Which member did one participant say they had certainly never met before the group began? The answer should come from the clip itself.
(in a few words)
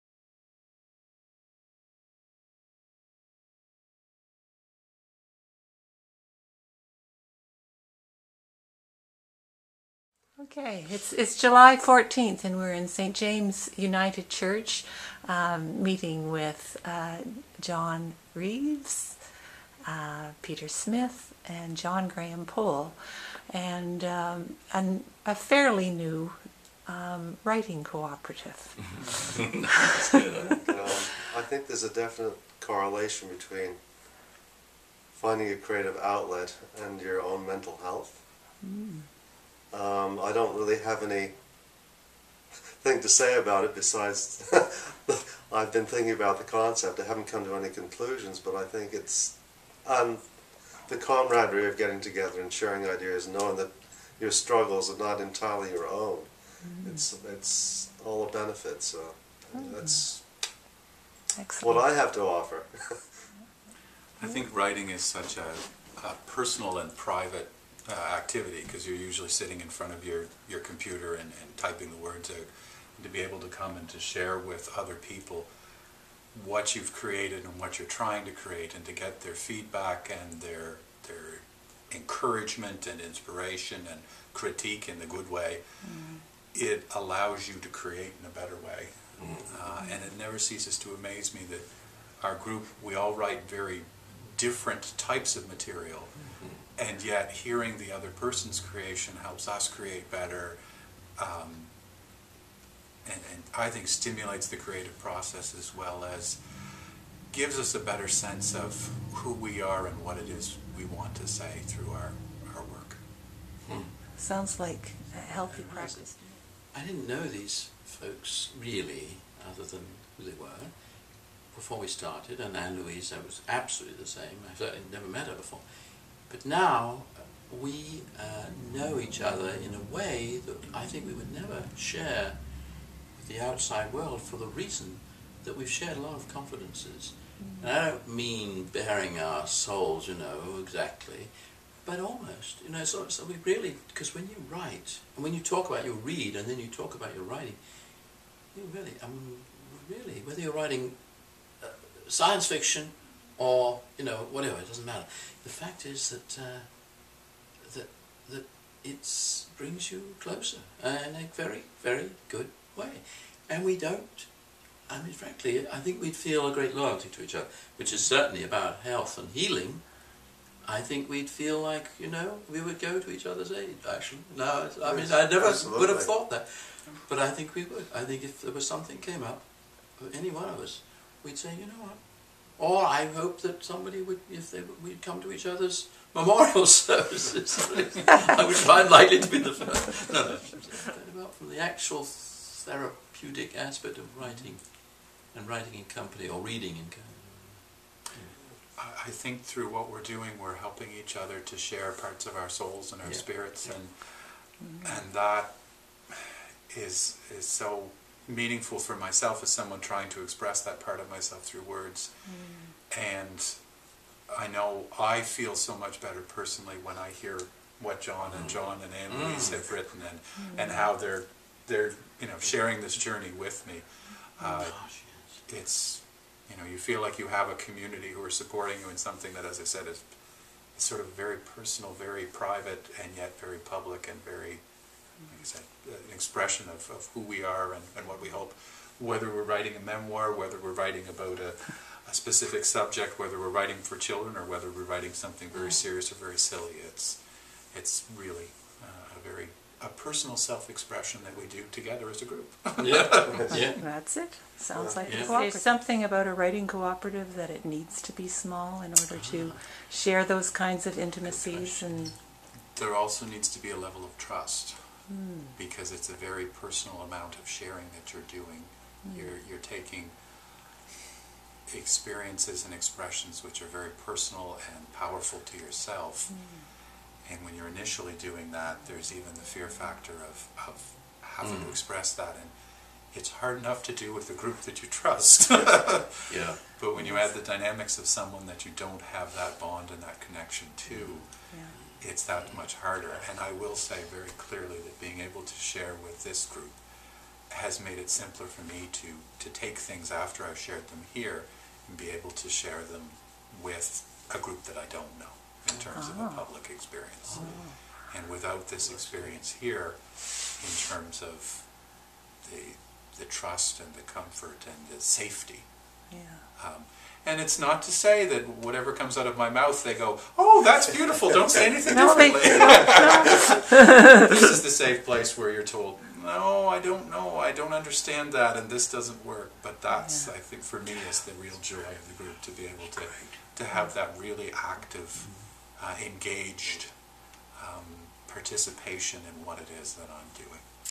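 Anne-Louise.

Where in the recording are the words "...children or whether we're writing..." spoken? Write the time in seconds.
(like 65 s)
243 s.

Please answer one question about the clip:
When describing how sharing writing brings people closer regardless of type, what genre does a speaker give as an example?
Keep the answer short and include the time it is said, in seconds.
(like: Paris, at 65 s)
Science fiction, at 152 s.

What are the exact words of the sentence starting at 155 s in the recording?
The fact is that uh, that that it brings you closer in a very very good way, and we don't.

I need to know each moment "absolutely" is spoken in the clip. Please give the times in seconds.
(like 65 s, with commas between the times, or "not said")
123 s, 175 s.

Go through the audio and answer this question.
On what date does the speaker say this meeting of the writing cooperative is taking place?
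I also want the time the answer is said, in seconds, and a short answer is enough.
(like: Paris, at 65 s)
July 14th, at 11 s.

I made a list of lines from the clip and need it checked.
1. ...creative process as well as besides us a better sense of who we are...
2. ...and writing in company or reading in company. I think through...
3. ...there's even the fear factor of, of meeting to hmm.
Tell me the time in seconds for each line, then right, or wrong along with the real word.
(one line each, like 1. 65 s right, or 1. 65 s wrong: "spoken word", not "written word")
1. 104 s wrong: "gives", not "besides"
2. 195 s right
3. 278 s wrong: "having", not "meeting".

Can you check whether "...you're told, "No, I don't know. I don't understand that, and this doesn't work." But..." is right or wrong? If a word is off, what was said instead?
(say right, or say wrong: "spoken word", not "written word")
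right.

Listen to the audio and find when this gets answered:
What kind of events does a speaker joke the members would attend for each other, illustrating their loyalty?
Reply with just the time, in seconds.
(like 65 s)
186 s.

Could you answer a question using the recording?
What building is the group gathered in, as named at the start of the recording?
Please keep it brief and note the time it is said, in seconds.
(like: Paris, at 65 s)
St. James United Church, at 12 s.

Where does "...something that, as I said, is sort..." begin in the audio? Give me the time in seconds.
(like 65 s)
228 s.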